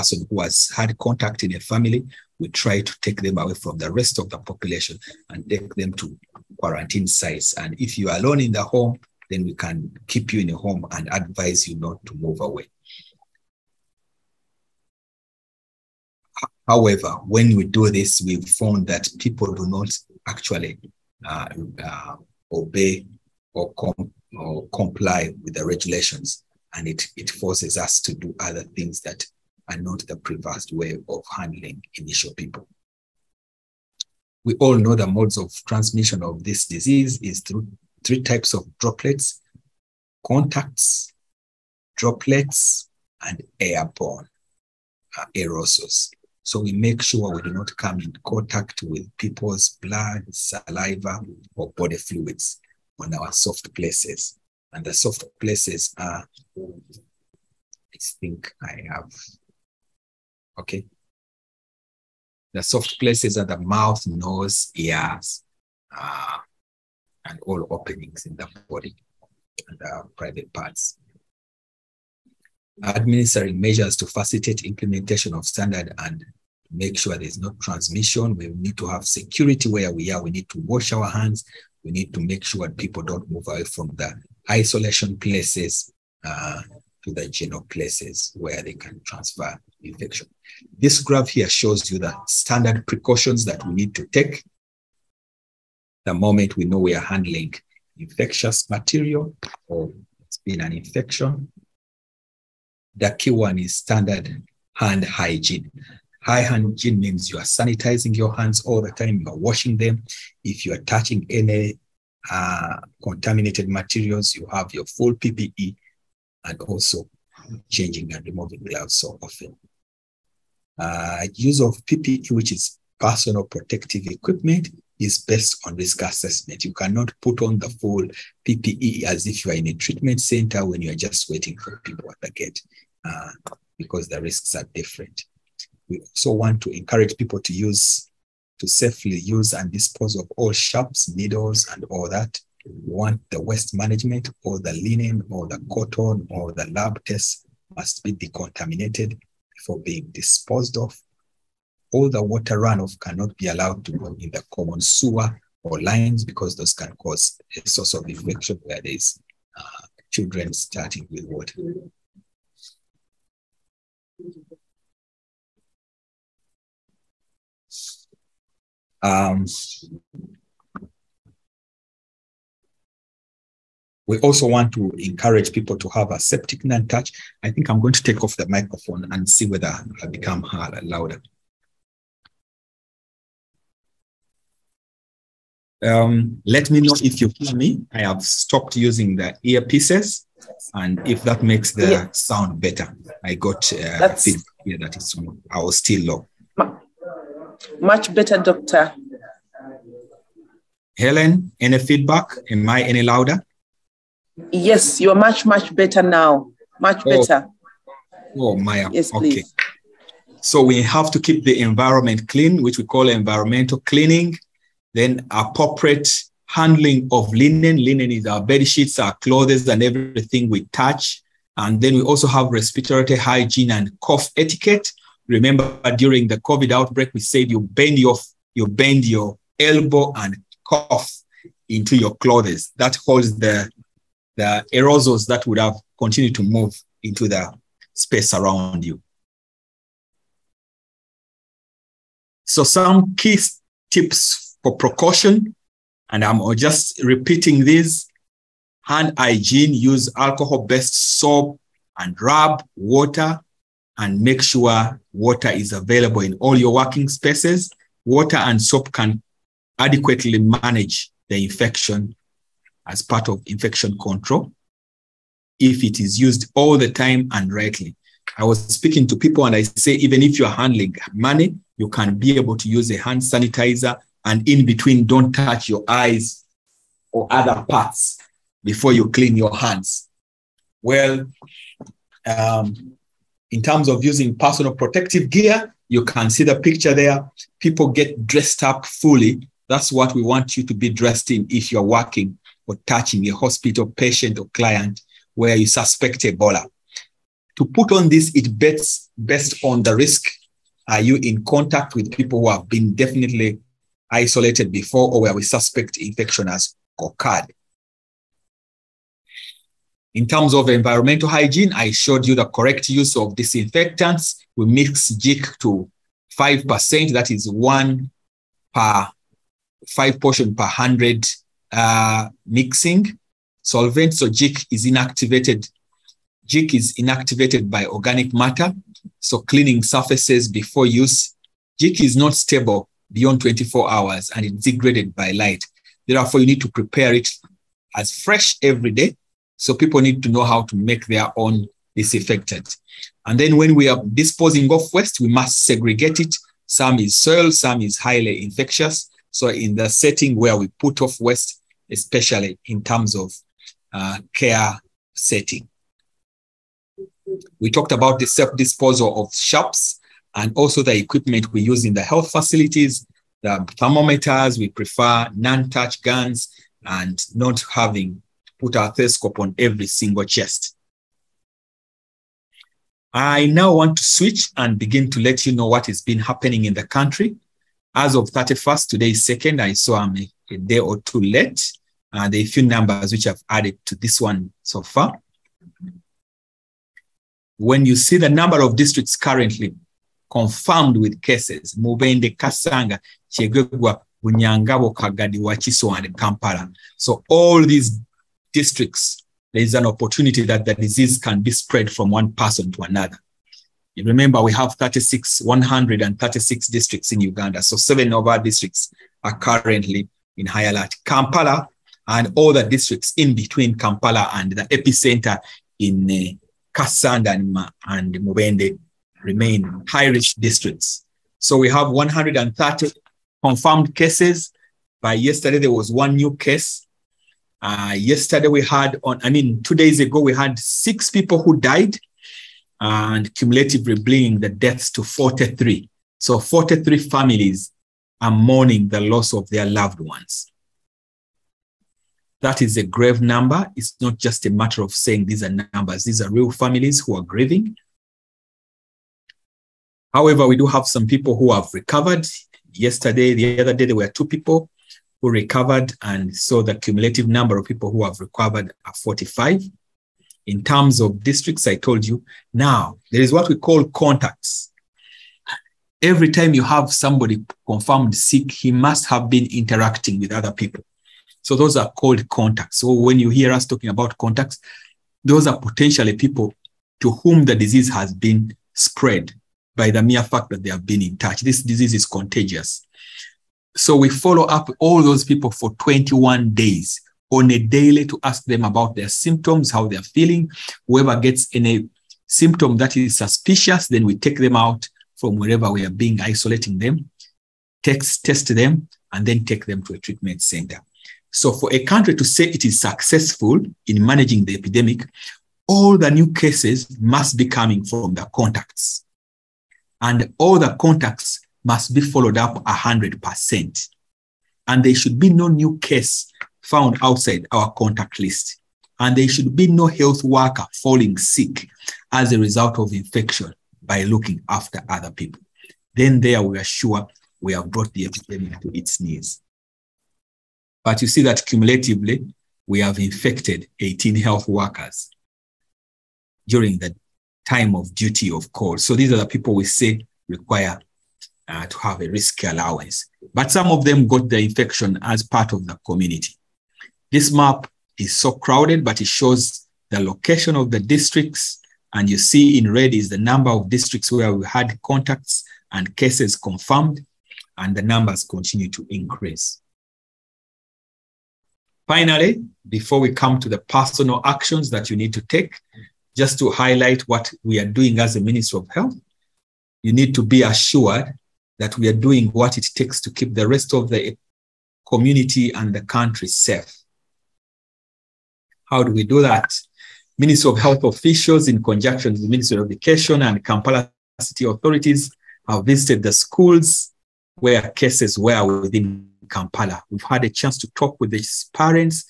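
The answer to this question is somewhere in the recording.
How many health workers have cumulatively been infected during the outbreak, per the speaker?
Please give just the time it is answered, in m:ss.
8:53.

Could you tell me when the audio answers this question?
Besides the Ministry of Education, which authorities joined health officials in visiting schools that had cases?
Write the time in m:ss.
9:43.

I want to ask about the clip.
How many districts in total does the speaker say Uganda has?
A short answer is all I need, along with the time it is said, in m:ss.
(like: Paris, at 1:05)
136, at 6:45.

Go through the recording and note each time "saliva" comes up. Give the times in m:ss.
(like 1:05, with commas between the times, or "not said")
0:50.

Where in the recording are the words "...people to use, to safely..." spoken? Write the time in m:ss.
2:17.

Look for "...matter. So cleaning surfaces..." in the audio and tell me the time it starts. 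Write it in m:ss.
5:28.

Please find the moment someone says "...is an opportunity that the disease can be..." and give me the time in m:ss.
6:39.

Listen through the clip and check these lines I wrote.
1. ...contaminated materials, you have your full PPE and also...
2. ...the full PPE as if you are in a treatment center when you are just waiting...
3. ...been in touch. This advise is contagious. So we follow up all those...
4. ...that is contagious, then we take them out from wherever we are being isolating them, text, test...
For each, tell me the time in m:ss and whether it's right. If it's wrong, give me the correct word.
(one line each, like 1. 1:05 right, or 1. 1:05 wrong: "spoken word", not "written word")
1. 1:53 right
2. 2:07 right
3. 8:00 wrong: "disease", not "advise"
4. 8:12 wrong: "suspicious", not "contagious".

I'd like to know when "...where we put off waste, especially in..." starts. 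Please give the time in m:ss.
5:50.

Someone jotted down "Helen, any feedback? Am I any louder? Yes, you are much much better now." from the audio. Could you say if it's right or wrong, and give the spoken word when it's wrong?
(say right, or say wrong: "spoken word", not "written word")
right.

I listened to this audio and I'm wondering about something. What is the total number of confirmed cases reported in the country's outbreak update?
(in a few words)
130.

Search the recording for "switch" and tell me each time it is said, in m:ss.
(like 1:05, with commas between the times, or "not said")
6:14.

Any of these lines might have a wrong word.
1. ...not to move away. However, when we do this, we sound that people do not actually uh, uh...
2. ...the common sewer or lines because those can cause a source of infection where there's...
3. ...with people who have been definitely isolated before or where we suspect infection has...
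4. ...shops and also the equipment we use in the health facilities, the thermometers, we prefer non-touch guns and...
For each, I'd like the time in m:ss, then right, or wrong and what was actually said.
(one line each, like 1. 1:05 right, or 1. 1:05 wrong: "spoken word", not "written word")
1. 0:11 wrong: "found", not "sound"
2. 2:34 right
3. 5:01 right
4. 5:59 right.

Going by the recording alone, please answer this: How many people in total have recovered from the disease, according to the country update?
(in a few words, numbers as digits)
45.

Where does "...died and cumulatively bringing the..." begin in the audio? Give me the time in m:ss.
7:11.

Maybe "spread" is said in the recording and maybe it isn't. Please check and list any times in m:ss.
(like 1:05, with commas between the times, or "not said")
6:41, 7:58.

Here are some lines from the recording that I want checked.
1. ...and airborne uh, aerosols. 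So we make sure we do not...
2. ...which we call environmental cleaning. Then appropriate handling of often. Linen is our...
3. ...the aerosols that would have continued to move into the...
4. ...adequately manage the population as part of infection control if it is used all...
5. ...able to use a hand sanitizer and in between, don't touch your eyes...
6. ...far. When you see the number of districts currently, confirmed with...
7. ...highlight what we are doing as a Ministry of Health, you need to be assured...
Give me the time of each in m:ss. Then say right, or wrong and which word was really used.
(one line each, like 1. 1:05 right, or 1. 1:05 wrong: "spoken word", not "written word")
1. 0:43 right
2. 3:32 wrong: "linen", not "often"
3. 3:54 right
4. 4:19 wrong: "infection", not "population"
5. 4:32 right
6. 6:24 right
7. 9:26 right.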